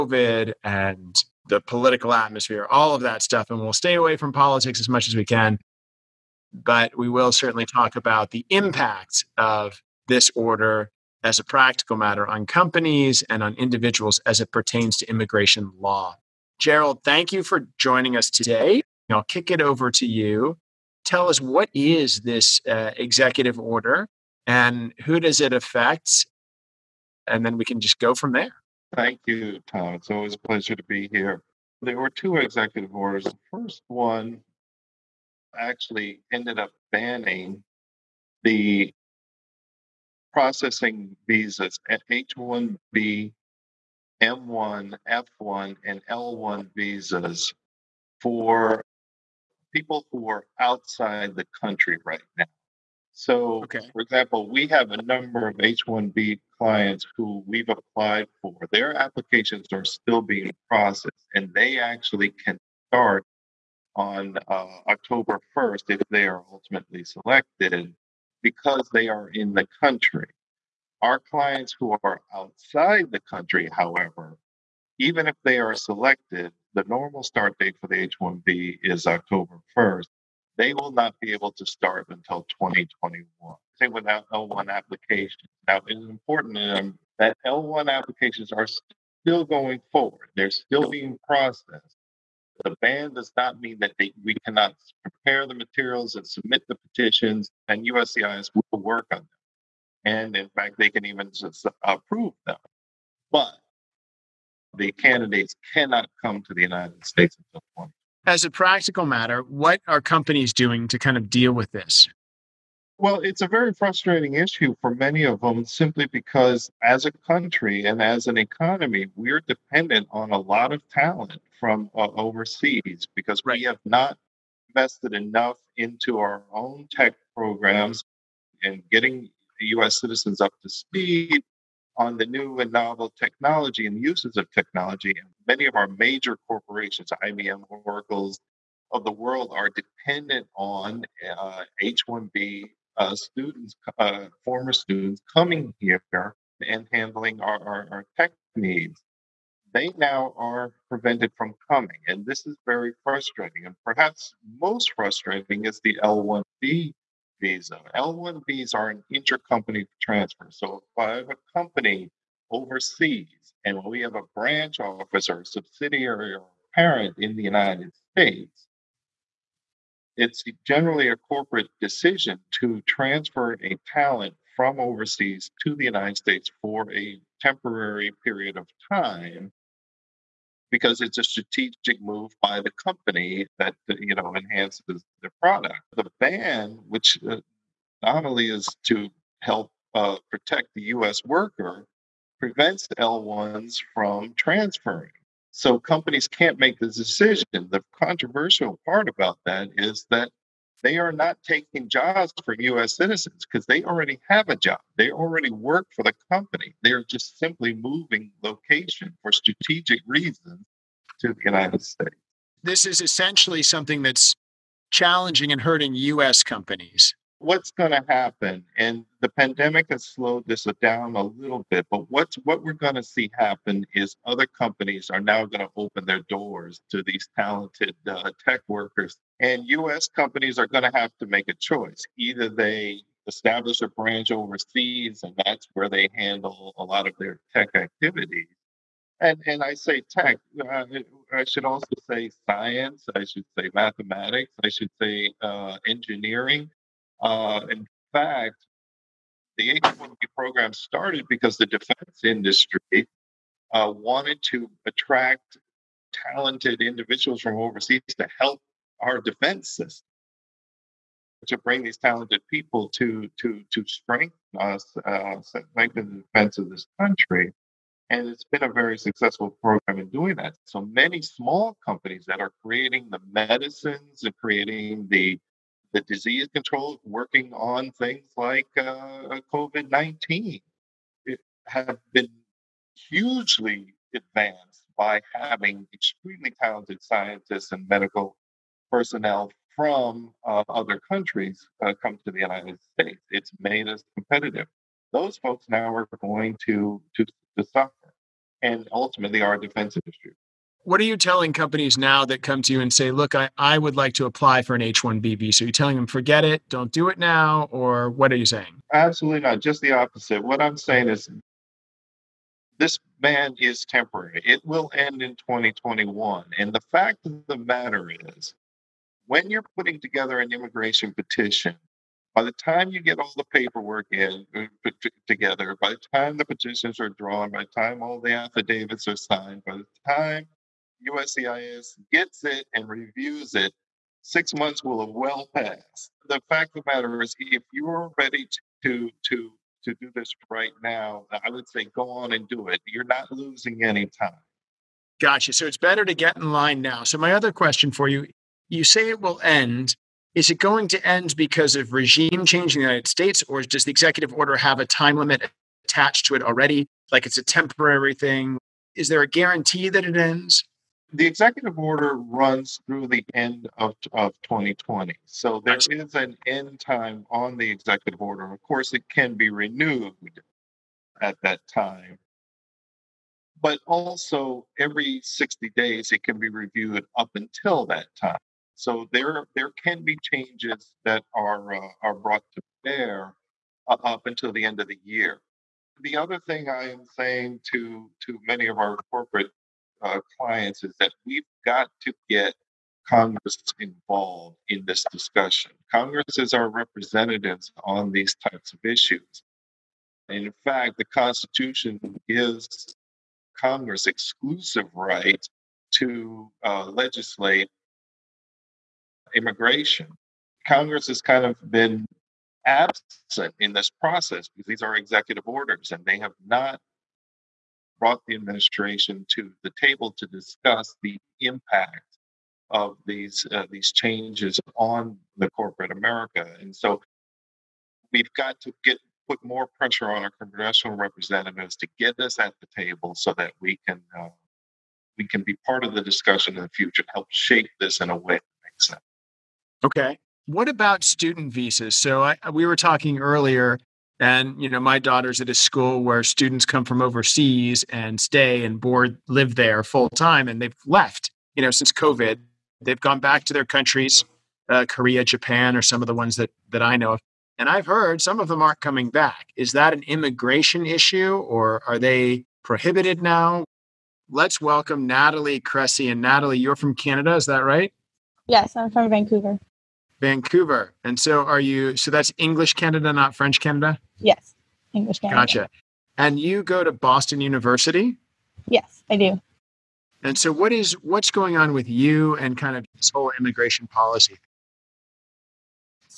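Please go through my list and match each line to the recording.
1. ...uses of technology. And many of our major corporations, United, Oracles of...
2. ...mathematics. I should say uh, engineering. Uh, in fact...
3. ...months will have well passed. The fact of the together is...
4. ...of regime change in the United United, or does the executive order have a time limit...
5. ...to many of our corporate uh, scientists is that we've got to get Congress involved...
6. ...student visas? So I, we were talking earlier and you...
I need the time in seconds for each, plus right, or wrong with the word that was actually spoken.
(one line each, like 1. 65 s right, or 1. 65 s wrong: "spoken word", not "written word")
1. 134 s wrong: "IBM", not "United"
2. 243 s right
3. 334 s wrong: "matter", not "together"
4. 351 s wrong: "States", not "United"
5. 388 s wrong: "clients", not "scientists"
6. 441 s right.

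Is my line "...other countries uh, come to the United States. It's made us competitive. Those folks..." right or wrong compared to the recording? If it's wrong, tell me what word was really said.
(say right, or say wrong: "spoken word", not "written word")
right.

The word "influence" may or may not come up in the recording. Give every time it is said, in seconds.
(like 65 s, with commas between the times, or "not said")
not said.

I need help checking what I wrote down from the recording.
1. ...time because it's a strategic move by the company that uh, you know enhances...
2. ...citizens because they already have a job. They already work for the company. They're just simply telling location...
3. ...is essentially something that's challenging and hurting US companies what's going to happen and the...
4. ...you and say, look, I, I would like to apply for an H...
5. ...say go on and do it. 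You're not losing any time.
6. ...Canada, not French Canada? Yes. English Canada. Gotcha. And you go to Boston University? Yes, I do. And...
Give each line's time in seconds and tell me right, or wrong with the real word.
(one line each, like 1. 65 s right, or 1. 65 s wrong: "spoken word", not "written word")
1. 178 s right
2. 202 s wrong: "moving", not "telling"
3. 212 s right
4. 302 s right
5. 341 s right
6. 472 s right.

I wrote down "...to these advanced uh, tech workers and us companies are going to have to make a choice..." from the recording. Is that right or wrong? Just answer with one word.
wrong.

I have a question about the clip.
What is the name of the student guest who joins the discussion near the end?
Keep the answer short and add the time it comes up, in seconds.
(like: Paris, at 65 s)
Natalie Cressey, at 465 s.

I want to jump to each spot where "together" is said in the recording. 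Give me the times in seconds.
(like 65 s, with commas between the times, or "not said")
319 s, 325 s.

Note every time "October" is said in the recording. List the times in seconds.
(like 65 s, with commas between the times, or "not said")
64 s, 79 s.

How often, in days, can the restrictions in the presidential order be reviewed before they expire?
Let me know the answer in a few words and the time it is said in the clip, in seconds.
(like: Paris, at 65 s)
60, at 375 s.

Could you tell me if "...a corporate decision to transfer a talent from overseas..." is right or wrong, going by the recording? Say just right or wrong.
right.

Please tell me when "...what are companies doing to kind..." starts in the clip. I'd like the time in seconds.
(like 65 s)
109 s.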